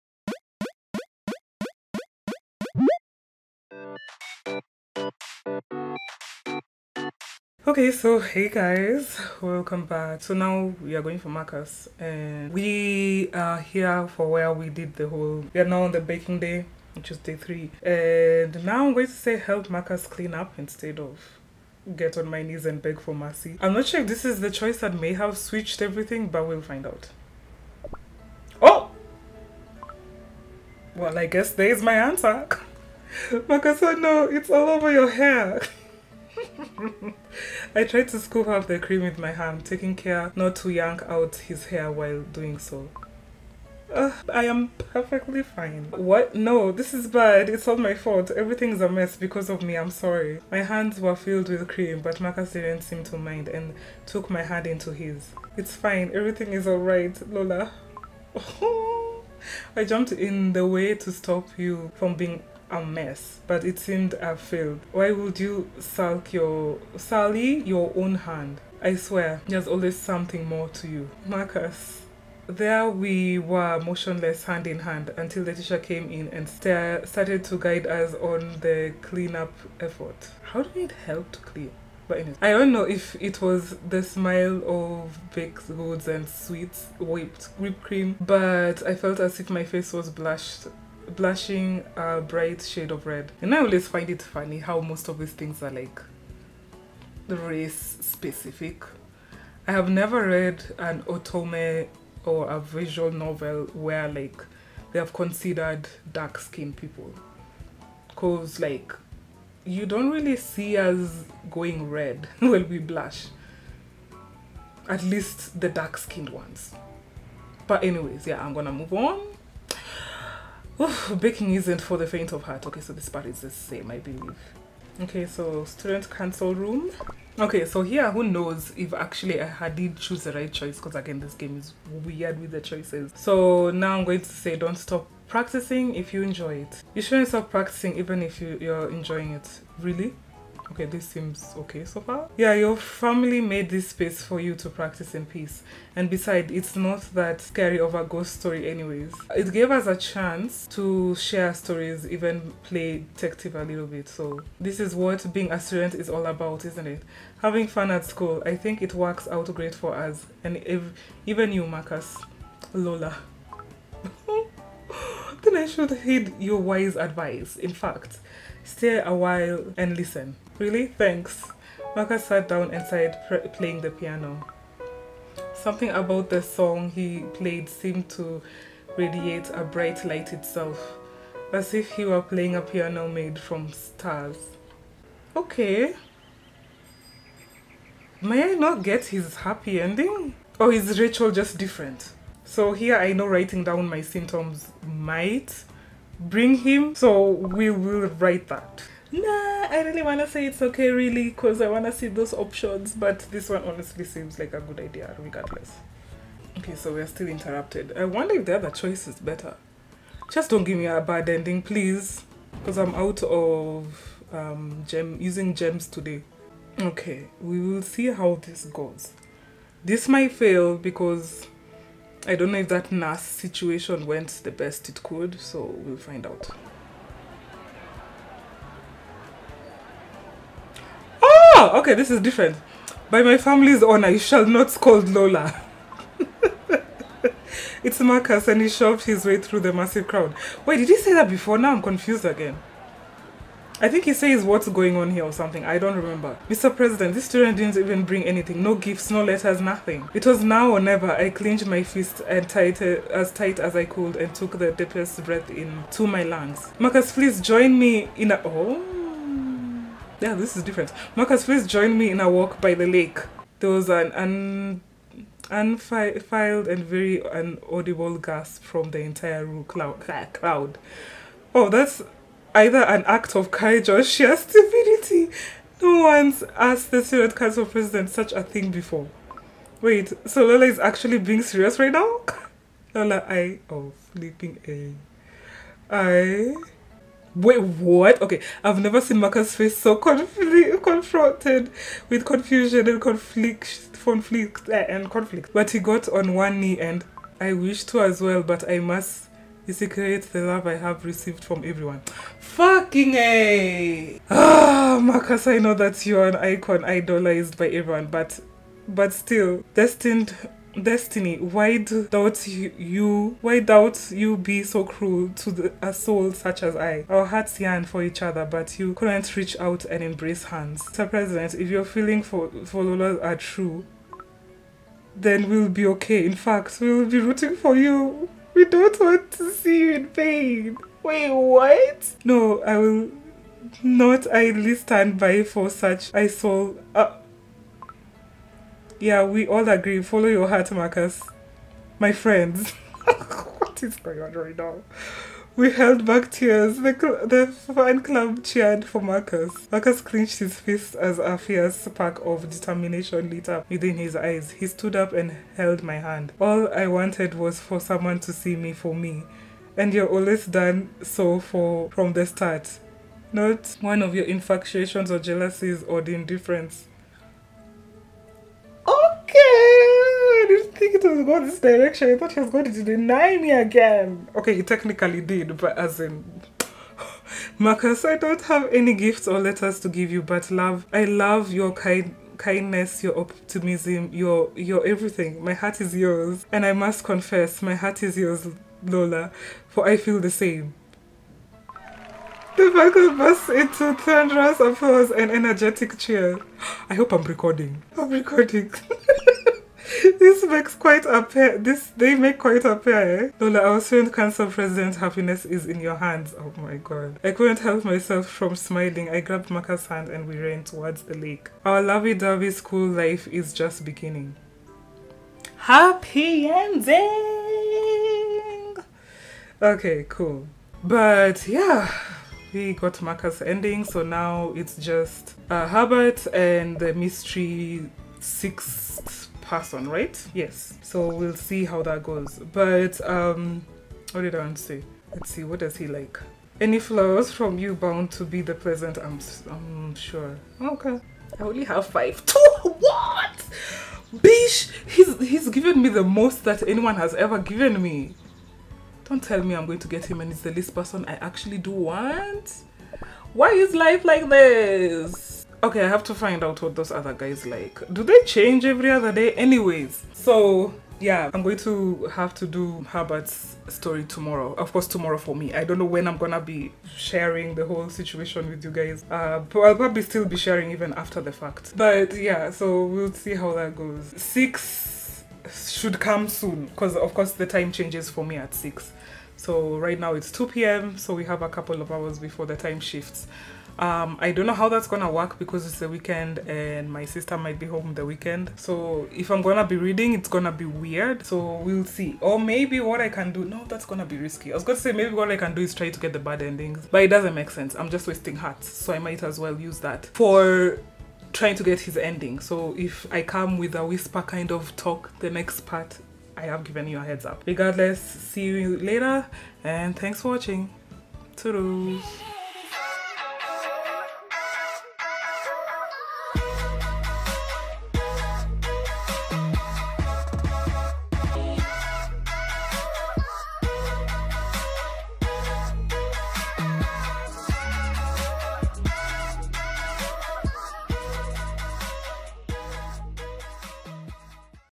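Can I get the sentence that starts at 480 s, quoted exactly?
So we have a couple of hours before the time shifts.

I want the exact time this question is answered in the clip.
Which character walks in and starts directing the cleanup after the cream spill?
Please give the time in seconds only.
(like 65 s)
75 s.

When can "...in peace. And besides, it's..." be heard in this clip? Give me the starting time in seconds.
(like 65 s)
145 s.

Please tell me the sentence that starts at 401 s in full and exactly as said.
This they make quite a pair.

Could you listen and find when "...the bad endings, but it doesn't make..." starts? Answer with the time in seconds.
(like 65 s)
496 s.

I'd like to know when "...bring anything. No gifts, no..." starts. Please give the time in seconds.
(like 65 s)
248 s.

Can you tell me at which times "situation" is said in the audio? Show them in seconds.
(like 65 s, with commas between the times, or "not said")
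223 s, 467 s.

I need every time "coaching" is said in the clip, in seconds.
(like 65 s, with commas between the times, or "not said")
not said.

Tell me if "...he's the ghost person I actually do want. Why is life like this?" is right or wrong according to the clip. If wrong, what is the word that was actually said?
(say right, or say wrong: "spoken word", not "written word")
wrong: "least", not "ghost".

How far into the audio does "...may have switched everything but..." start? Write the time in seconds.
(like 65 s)
24 s.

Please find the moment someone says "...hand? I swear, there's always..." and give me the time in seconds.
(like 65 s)
68 s.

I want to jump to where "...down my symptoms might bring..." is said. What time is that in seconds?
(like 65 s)
193 s.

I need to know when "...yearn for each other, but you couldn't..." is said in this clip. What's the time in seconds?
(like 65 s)
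317 s.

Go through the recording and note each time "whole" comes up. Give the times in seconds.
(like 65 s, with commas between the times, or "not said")
15 s, 467 s.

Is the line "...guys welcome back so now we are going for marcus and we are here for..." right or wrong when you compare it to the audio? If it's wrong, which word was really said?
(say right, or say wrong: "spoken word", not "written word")
right.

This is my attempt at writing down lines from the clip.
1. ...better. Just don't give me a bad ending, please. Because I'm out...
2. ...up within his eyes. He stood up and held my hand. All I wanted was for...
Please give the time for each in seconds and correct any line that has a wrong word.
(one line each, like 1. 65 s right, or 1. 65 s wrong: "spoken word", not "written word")
1. 209 s right
2. 353 s right.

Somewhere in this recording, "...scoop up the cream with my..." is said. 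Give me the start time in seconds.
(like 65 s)
38 s.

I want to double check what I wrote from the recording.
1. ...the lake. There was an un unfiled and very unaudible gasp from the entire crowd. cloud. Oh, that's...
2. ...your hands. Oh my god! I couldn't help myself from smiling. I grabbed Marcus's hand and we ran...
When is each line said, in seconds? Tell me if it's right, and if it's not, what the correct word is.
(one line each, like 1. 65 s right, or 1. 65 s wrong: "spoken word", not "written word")
1. 262 s right
2. 405 s right.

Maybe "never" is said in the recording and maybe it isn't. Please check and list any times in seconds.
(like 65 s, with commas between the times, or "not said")
99 s, 250 s, 288 s.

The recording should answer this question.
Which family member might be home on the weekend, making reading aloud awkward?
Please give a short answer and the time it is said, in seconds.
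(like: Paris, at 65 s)
Sister, at 487 s.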